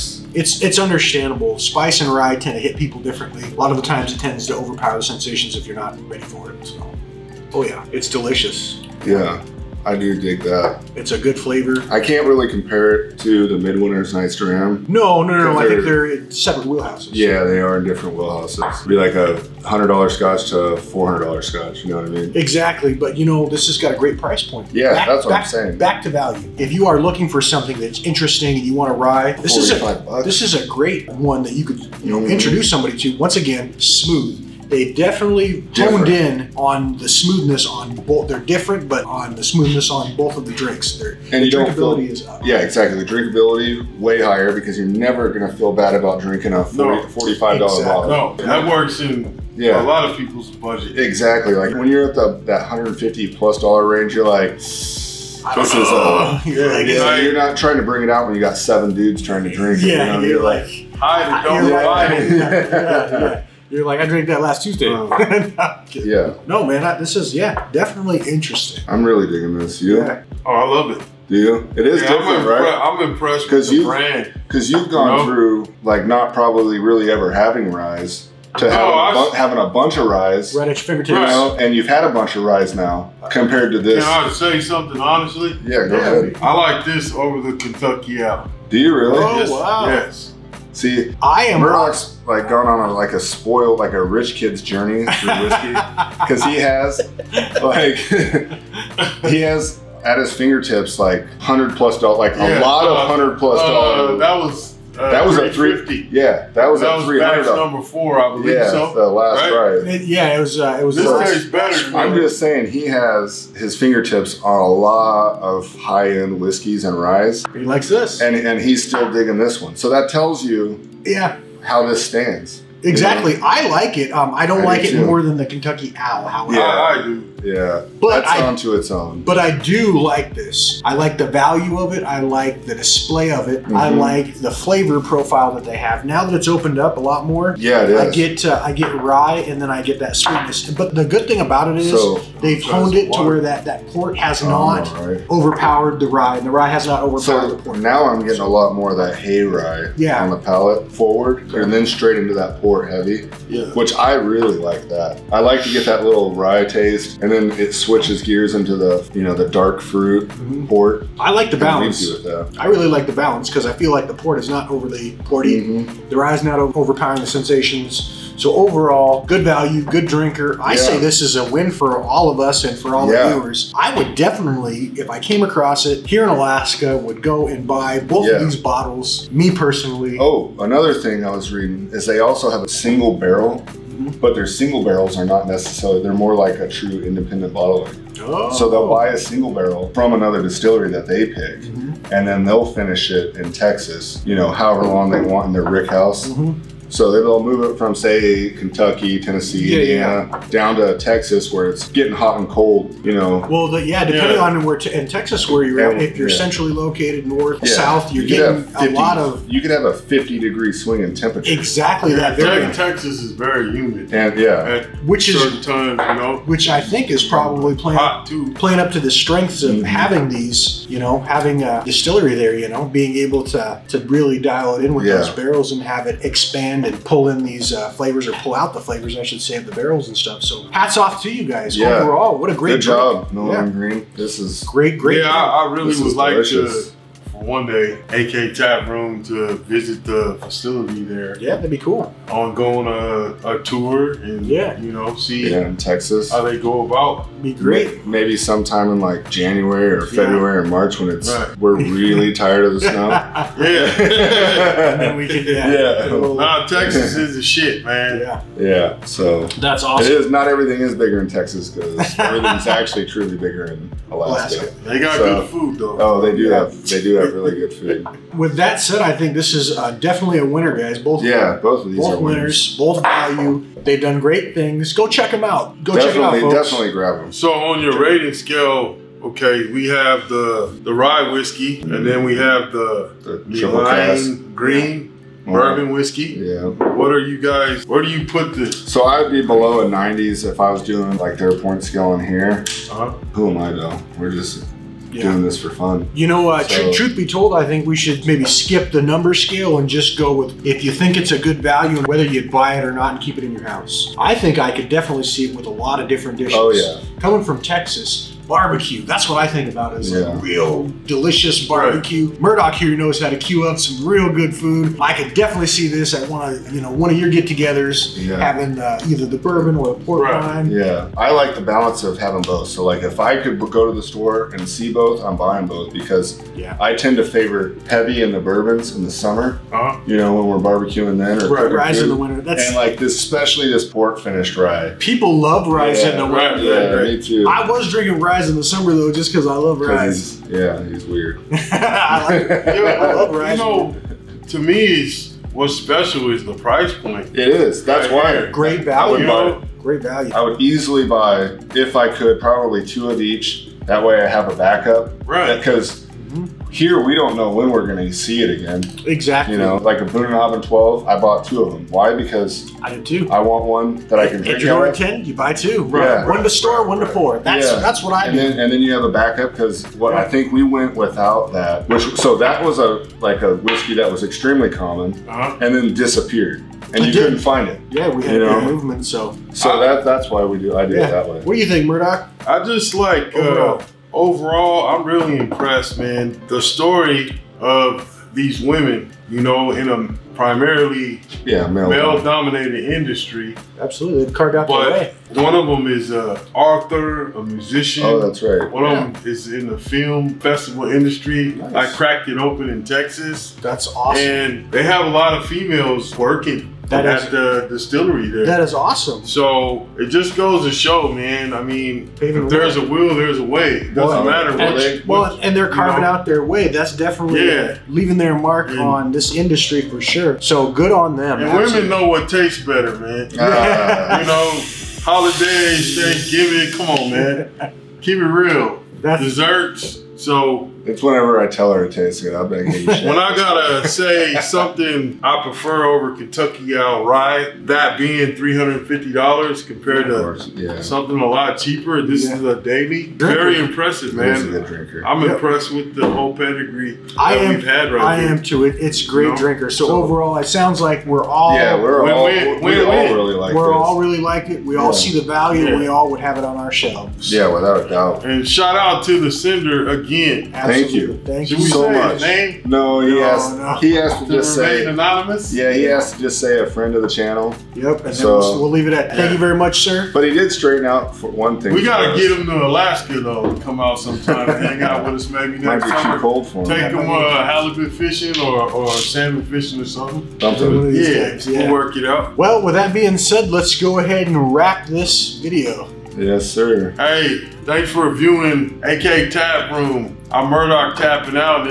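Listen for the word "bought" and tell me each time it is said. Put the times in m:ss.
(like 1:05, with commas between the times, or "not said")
6:01.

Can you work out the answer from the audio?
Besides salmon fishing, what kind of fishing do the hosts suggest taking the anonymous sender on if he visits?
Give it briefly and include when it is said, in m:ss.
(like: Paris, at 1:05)
halibut fishing, at 7:57.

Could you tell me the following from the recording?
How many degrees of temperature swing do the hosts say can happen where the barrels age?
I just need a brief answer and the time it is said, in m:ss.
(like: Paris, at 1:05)
50, at 3:29.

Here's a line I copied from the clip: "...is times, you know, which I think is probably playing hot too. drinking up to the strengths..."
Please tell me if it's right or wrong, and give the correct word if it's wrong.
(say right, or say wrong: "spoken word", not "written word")
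wrong: "playing", not "drinking".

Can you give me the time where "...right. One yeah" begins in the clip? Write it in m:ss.
6:38.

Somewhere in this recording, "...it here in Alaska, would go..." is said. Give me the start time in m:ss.
2:55.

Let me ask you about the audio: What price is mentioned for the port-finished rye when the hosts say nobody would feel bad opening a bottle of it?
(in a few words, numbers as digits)
$45.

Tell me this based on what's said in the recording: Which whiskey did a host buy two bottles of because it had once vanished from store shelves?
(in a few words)
Boone and 12.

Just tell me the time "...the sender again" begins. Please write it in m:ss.
7:39.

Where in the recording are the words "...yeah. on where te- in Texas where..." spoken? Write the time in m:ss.
3:24.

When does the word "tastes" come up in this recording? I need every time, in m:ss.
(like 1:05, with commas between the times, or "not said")
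1:51, 2:36, 7:02, 7:11.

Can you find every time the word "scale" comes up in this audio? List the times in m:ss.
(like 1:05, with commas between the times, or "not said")
4:38, 4:51, 4:59.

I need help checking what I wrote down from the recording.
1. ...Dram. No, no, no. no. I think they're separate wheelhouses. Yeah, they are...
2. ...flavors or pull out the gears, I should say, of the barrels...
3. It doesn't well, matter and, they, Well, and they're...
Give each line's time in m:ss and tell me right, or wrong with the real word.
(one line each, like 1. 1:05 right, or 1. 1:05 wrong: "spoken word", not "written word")
1. 0:14 right
2. 3:47 wrong: "flavors", not "gears"
3. 6:53 right.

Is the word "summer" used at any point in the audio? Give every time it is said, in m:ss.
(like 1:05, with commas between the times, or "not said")
5:29, 5:38, 7:56.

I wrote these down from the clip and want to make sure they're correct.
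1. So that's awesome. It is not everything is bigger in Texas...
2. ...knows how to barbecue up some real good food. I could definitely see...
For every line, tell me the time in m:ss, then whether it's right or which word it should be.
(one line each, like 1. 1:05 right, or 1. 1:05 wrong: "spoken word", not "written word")
1. 4:19 right
2. 5:12 wrong: "queue", not "barbecue".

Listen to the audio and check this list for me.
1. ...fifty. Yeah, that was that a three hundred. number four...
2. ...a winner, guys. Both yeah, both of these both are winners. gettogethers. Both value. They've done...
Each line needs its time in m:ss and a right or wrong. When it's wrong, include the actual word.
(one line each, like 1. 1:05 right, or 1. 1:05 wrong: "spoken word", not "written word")
1. 1:45 right
2. 4:30 wrong: "winners", not "gettogethers".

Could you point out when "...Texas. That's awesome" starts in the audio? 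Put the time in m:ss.
6:42.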